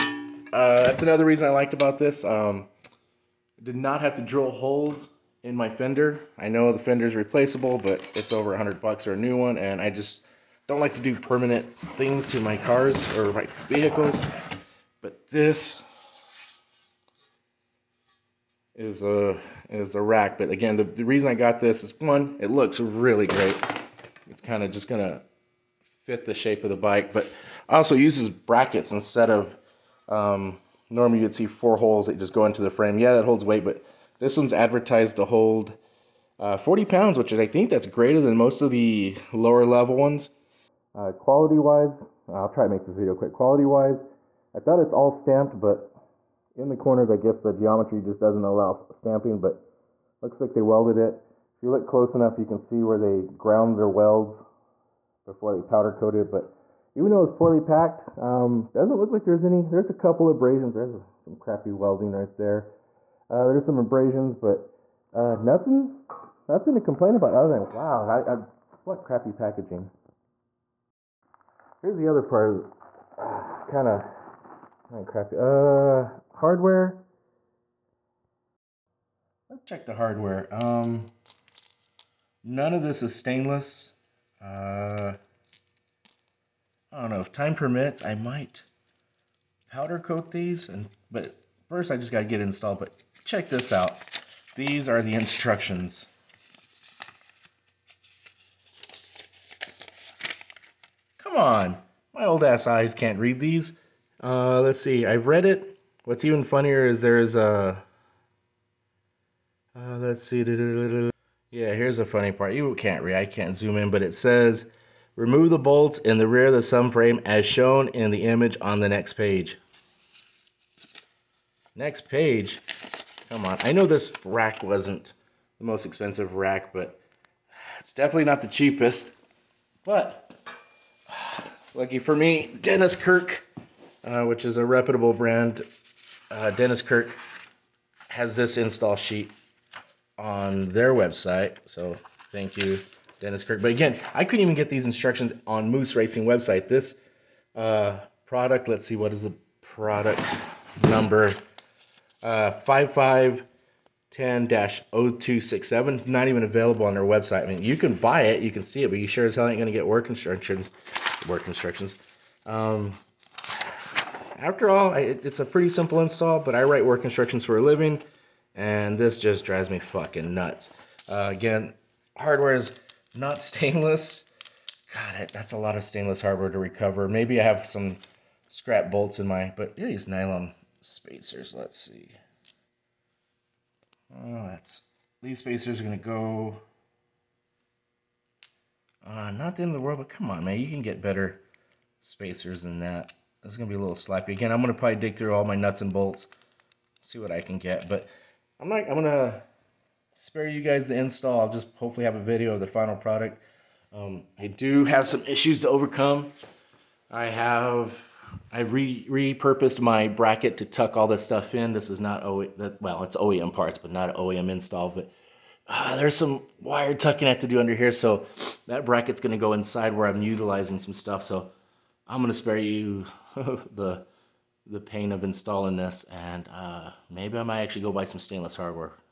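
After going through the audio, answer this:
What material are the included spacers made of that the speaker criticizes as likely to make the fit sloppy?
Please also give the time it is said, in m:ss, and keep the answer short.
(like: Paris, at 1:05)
nylon, at 3:00.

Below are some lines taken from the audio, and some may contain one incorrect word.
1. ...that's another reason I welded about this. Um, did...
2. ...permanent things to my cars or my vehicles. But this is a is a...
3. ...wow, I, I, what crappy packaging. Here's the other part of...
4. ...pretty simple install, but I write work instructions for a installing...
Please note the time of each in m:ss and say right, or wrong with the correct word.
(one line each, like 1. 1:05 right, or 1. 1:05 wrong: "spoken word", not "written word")
1. 0:00 wrong: "liked", not "welded"
2. 0:11 right
3. 1:07 right
4. 2:45 wrong: "living", not "installing".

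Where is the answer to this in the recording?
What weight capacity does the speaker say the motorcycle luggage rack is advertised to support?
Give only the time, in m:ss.
0:36.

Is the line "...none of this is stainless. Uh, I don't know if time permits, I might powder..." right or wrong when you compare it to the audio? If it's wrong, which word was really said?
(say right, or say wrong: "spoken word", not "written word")
right.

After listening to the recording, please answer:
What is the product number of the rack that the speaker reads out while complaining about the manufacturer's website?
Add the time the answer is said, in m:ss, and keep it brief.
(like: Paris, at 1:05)
5510-0267, at 2:32.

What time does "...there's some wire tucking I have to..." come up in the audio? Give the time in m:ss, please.
3:35.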